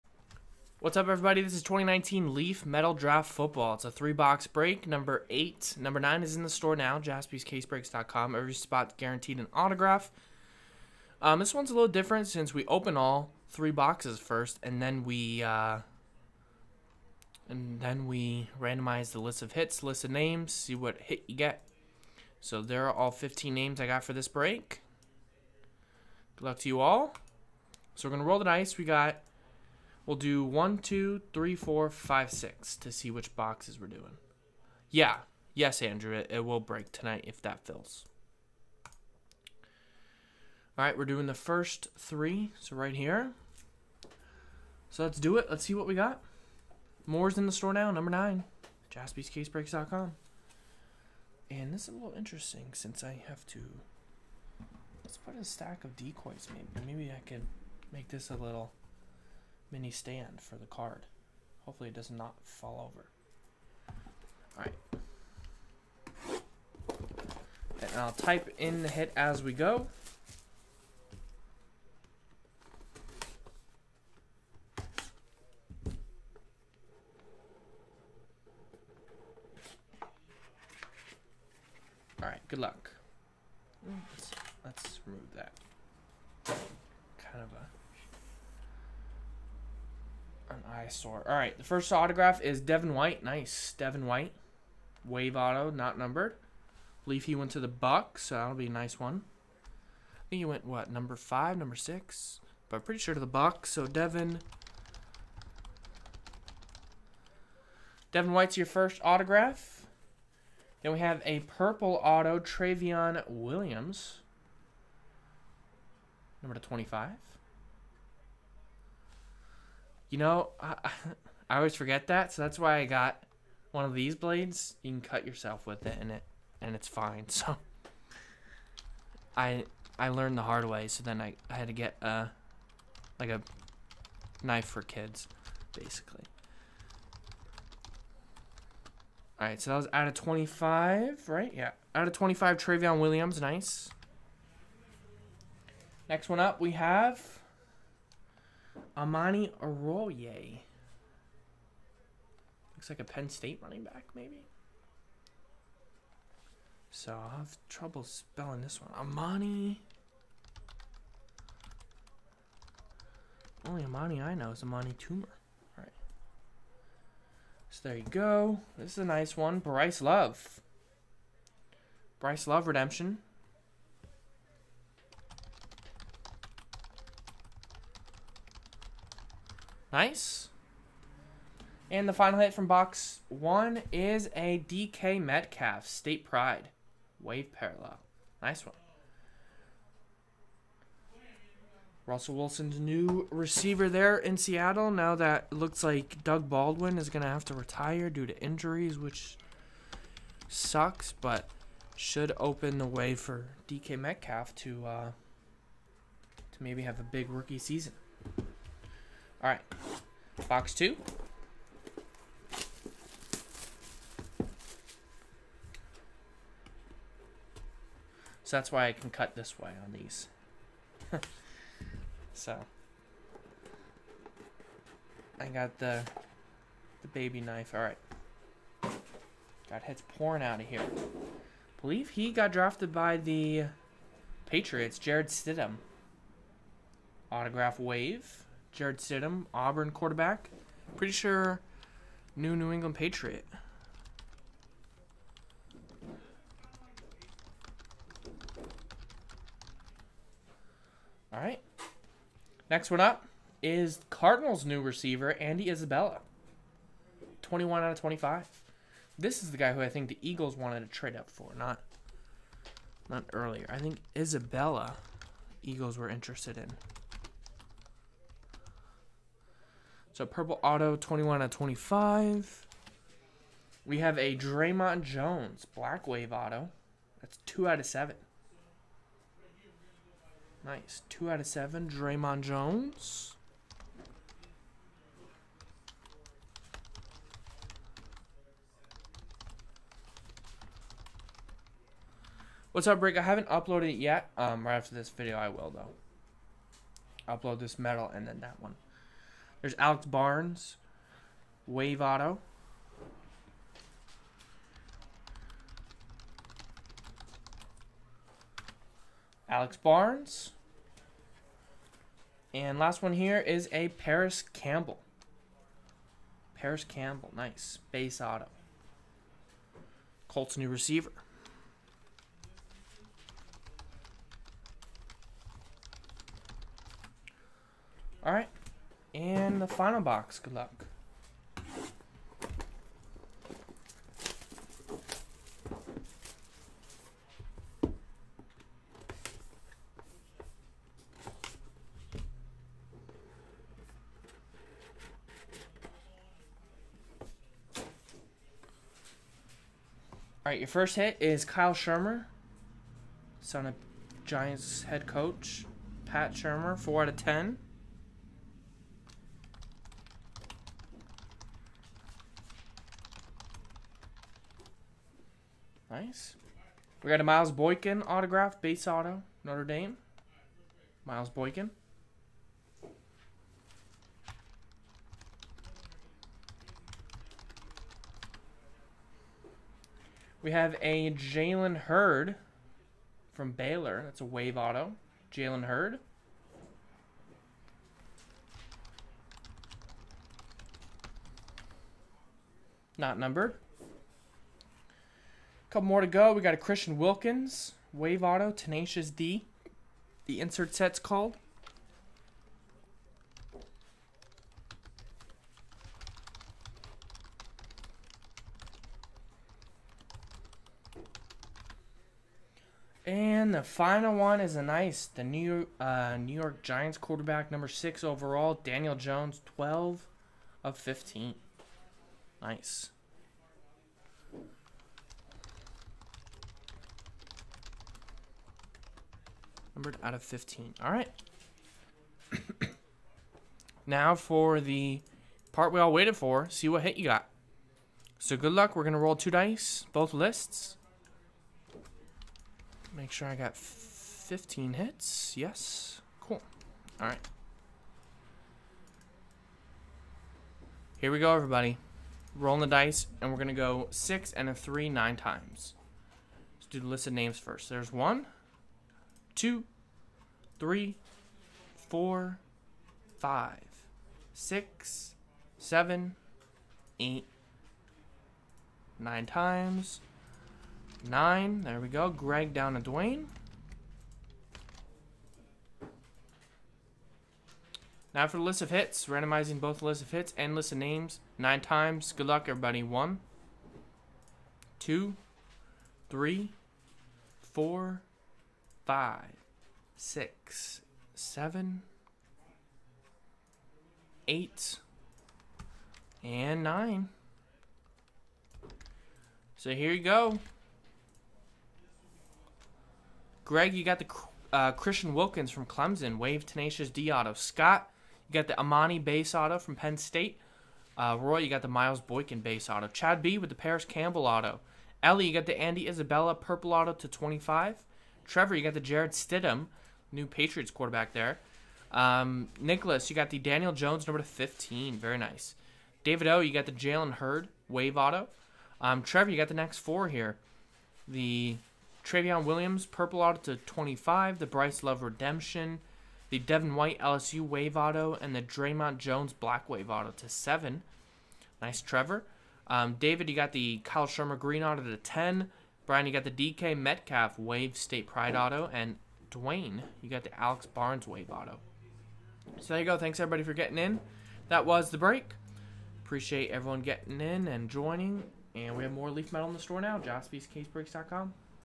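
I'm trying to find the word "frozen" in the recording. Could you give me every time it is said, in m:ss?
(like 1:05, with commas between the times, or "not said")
not said.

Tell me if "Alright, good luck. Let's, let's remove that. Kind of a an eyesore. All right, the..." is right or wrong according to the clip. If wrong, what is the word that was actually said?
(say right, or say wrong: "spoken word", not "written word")
right.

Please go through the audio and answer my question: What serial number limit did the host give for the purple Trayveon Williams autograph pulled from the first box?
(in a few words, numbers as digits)
25.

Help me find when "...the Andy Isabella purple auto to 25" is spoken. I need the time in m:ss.
8:35.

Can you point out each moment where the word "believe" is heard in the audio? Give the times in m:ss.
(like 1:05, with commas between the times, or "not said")
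1:37, 3:51.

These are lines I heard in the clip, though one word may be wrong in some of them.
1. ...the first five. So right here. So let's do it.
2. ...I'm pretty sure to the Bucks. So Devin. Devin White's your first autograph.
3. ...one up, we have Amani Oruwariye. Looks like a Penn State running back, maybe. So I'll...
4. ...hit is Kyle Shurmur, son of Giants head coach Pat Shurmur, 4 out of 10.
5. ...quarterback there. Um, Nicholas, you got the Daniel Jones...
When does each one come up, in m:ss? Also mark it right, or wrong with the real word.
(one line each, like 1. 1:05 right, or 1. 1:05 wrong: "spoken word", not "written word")
1. 0:41 wrong: "three", not "five"
2. 1:42 right
3. 2:26 right
4. 5:50 right
5. 8:40 right.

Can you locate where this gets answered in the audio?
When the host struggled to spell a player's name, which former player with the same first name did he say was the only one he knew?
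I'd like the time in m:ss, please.
2:44.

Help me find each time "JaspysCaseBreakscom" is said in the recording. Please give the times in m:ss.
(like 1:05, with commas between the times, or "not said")
0:06, 0:48, 9:19.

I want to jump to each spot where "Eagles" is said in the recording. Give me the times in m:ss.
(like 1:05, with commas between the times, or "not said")
4:20, 4:25.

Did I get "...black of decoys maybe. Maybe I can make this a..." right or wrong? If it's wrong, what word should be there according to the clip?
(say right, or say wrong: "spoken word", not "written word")
wrong: "stack", not "black".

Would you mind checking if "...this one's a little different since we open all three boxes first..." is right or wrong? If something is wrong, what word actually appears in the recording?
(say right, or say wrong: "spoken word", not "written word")
right.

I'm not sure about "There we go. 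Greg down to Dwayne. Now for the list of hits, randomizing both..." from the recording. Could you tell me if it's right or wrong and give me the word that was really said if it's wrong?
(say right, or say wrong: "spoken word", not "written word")
right.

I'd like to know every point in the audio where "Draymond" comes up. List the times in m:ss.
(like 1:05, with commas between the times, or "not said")
4:34, 4:41, 8:58.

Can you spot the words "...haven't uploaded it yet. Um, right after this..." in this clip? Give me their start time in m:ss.
4:53.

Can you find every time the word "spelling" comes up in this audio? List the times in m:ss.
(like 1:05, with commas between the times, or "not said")
2:38.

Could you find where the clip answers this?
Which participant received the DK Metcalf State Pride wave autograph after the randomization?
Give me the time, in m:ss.
9:05.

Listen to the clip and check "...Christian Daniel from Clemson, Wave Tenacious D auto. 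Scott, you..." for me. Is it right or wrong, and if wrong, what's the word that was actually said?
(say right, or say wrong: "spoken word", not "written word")
wrong: "Wilkins", not "Daniel".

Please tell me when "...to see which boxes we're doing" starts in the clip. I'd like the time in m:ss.
0:32.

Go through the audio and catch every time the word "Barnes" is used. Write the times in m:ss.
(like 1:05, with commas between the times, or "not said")
5:00, 5:09, 9:10.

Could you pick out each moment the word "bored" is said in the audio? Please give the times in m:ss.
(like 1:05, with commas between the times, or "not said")
not said.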